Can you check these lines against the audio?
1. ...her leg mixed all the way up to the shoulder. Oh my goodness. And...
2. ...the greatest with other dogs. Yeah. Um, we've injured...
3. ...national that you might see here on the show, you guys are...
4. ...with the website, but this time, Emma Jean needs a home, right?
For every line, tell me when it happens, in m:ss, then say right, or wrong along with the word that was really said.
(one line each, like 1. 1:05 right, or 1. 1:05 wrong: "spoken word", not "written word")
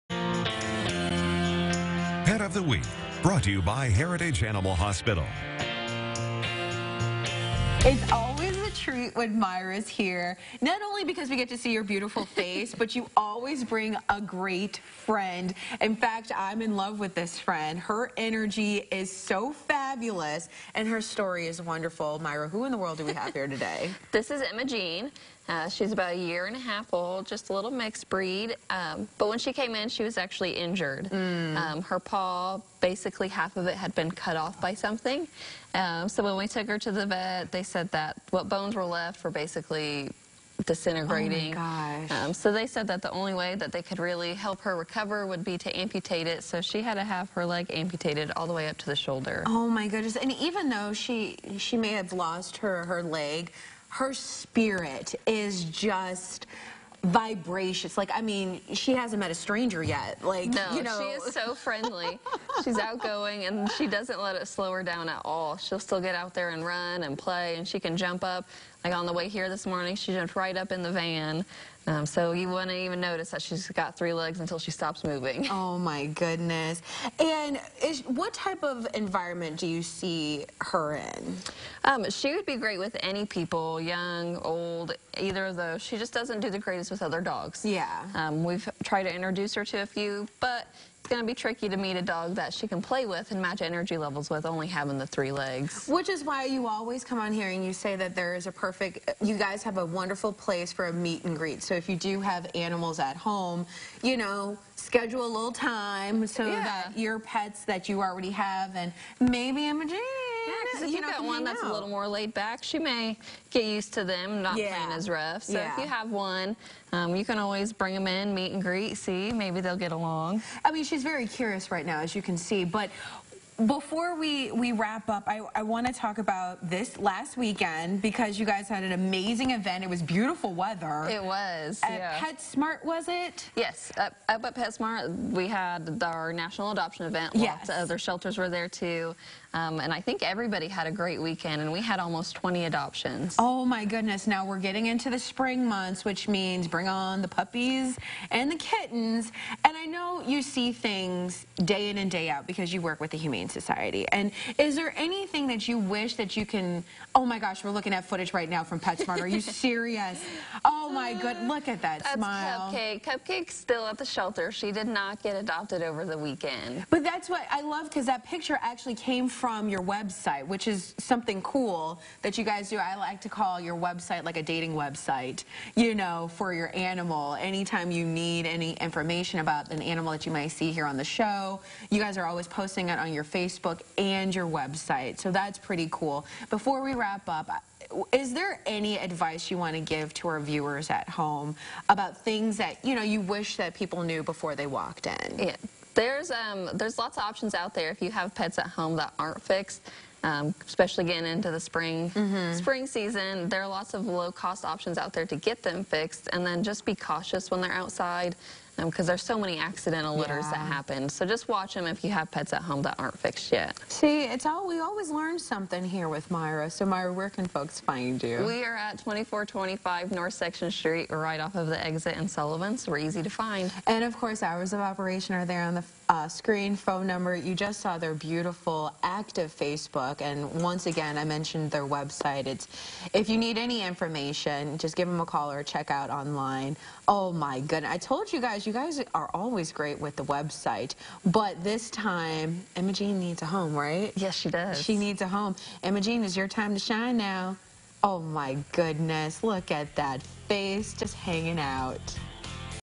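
1. 0:47 wrong: "amputated", not "mixed"
2. 1:26 wrong: "tried", not "injured"
3. 2:59 wrong: "animal", not "national"
4. 3:59 right.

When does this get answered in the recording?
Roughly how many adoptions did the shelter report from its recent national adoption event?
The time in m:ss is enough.
2:21.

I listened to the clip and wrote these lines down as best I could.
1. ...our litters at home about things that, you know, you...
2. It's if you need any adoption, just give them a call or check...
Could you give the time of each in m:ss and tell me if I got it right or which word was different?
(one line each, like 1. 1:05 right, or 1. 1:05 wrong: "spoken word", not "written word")
1. 3:10 wrong: "viewers", not "litters"
2. 3:52 wrong: "information", not "adoption".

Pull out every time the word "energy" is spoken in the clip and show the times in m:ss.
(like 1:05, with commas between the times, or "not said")
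0:18, 1:33.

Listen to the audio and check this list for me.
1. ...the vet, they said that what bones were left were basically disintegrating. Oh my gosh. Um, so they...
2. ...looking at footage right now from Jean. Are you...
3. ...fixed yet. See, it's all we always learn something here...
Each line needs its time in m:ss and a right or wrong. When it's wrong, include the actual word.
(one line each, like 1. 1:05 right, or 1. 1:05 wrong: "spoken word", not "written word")
1. 0:36 right
2. 2:37 wrong: "PetSmart", not "Jean"
3. 3:33 right.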